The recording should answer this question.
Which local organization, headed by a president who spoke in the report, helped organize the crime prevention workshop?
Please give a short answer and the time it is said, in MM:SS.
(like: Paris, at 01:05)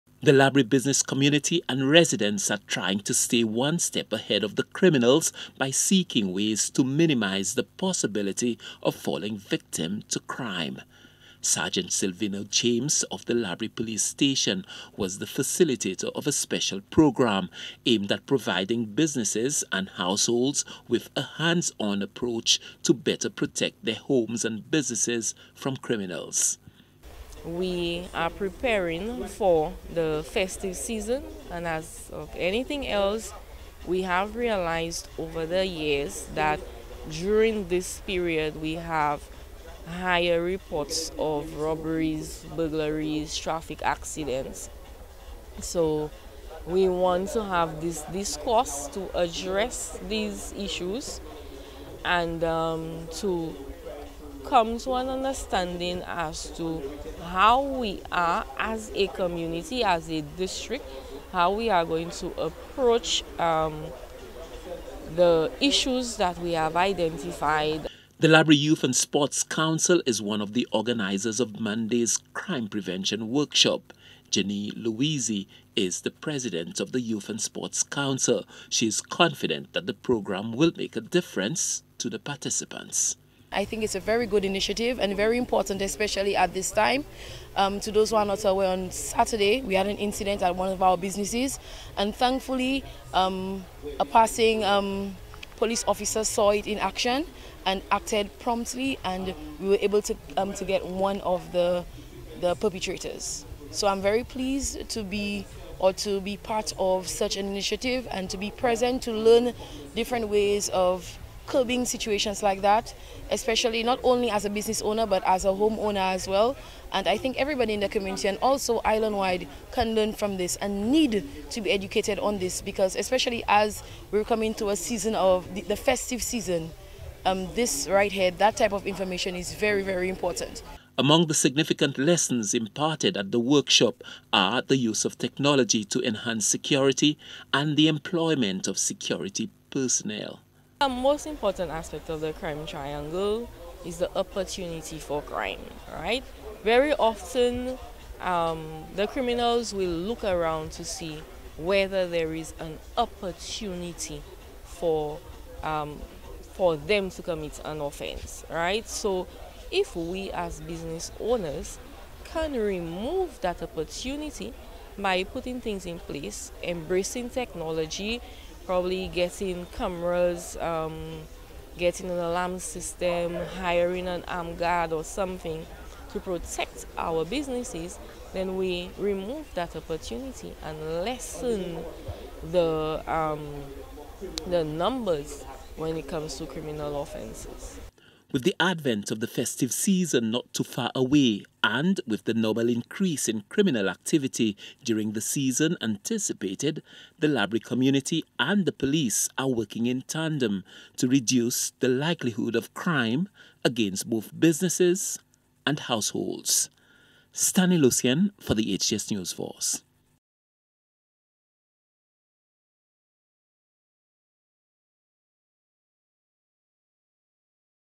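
Laborie Youth and Sports Council, at 01:08.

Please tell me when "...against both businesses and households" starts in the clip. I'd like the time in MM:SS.
03:23.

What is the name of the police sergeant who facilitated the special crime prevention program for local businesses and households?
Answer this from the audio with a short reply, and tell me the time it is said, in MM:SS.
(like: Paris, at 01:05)
Silvino James, at 00:11.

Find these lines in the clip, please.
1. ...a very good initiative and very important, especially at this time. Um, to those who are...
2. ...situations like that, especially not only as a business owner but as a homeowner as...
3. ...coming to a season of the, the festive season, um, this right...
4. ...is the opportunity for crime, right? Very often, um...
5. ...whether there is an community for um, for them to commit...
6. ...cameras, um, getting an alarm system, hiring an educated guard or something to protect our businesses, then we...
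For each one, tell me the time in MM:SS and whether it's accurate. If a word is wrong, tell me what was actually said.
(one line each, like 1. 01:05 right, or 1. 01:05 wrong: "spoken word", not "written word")
1. 01:23 right
2. 01:51 right
3. 02:04 right
4. 02:23 right
5. 02:31 wrong: "opportunity", not "community"
6. 02:49 wrong: "armed", not "educated".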